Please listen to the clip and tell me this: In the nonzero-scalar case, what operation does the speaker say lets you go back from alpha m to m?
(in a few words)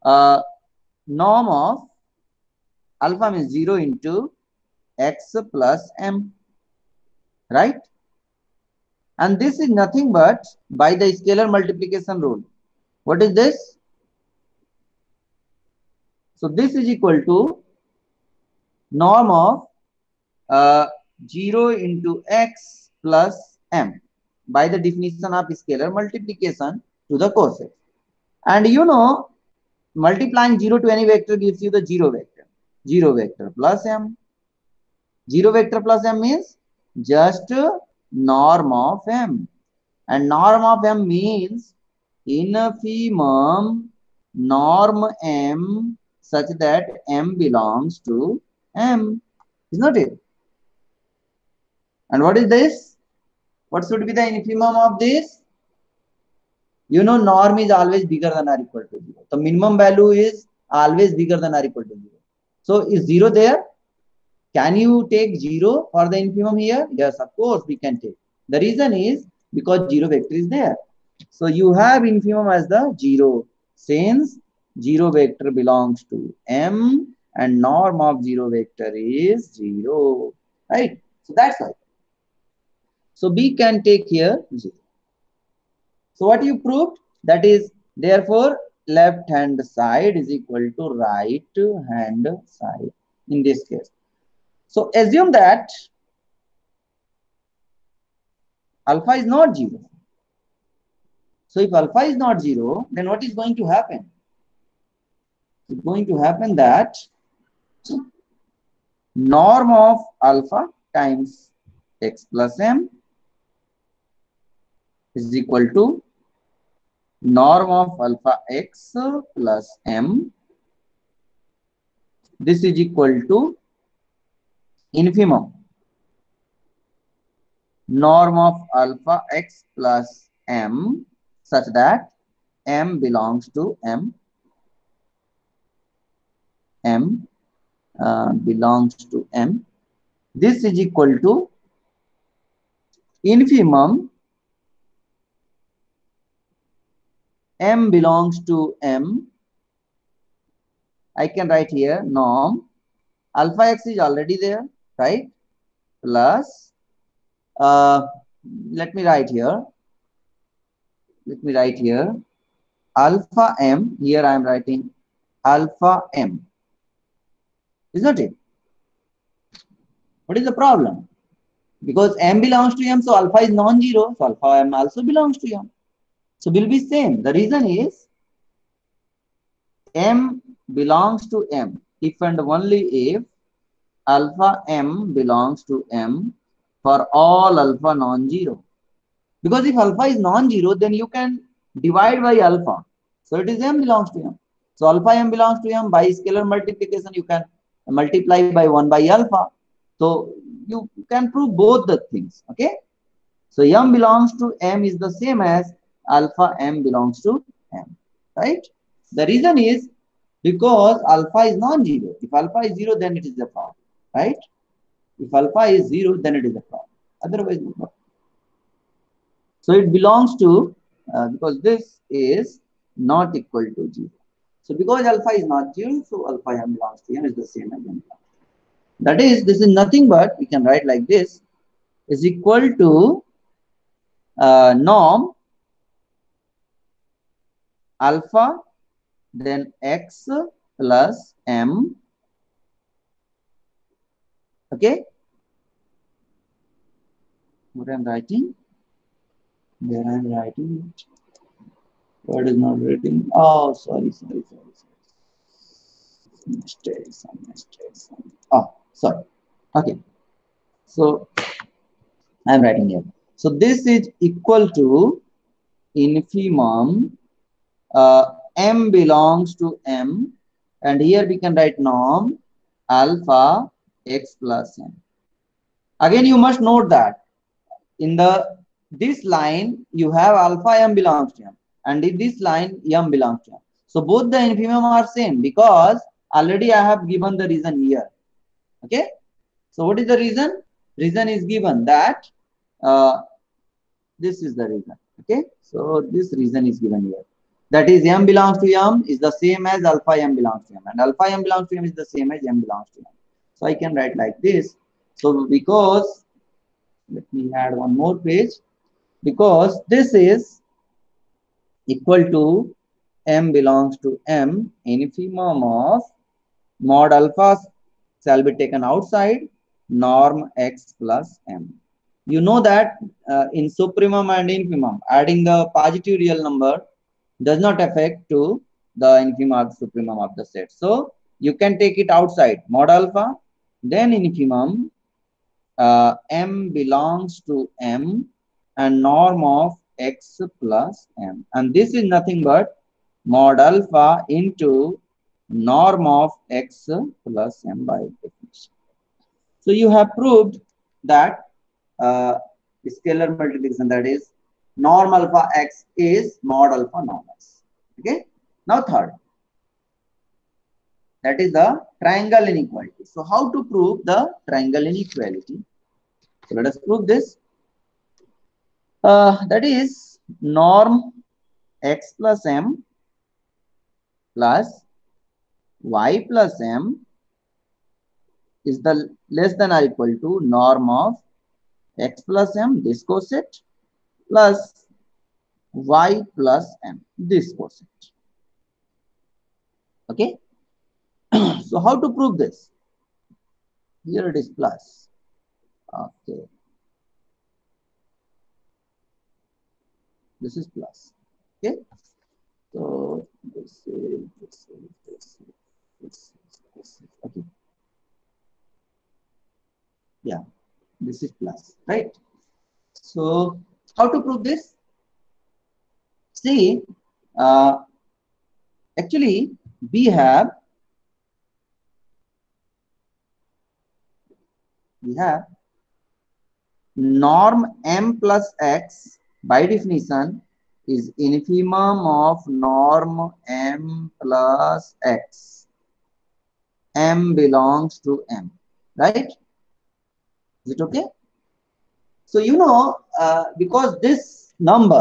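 divide by alpha.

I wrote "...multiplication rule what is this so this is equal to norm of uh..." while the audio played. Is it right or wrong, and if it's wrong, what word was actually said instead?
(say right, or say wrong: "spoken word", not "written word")
right.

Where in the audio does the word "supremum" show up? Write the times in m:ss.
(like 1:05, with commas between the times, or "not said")
5:23, 5:29.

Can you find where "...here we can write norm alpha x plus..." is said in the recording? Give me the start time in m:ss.
4:31.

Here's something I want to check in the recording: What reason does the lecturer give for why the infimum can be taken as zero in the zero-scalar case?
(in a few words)
0 vector belongs to m.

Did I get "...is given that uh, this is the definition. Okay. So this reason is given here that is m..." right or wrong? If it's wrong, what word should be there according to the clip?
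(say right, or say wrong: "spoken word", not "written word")
wrong: "reason", not "definition".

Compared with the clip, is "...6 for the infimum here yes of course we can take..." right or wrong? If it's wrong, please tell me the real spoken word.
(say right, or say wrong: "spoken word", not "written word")
wrong: "0", not "6".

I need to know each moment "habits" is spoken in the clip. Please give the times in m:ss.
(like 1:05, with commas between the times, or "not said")
not said.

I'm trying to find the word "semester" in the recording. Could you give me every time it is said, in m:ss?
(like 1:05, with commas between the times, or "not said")
not said.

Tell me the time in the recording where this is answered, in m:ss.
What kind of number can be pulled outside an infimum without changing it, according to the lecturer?
5:25.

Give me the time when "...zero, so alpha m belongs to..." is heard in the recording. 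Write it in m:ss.
3:45.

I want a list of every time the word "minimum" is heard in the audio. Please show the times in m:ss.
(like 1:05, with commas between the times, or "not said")
0:59.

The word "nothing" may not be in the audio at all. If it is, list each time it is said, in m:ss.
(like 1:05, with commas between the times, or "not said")
0:09, 3:49, 5:42.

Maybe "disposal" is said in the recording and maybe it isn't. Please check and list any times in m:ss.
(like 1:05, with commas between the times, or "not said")
not said.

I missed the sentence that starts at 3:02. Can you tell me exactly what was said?
If and only if alpha M belongs to M for all alpha non-zero.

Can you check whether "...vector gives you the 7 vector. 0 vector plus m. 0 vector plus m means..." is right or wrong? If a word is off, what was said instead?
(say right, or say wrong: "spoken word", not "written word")
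wrong: "0", not "7".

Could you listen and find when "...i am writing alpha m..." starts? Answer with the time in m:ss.
2:44.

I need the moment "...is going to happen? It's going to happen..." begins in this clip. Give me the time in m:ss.
1:43.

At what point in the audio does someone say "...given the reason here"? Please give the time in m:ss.
4:47.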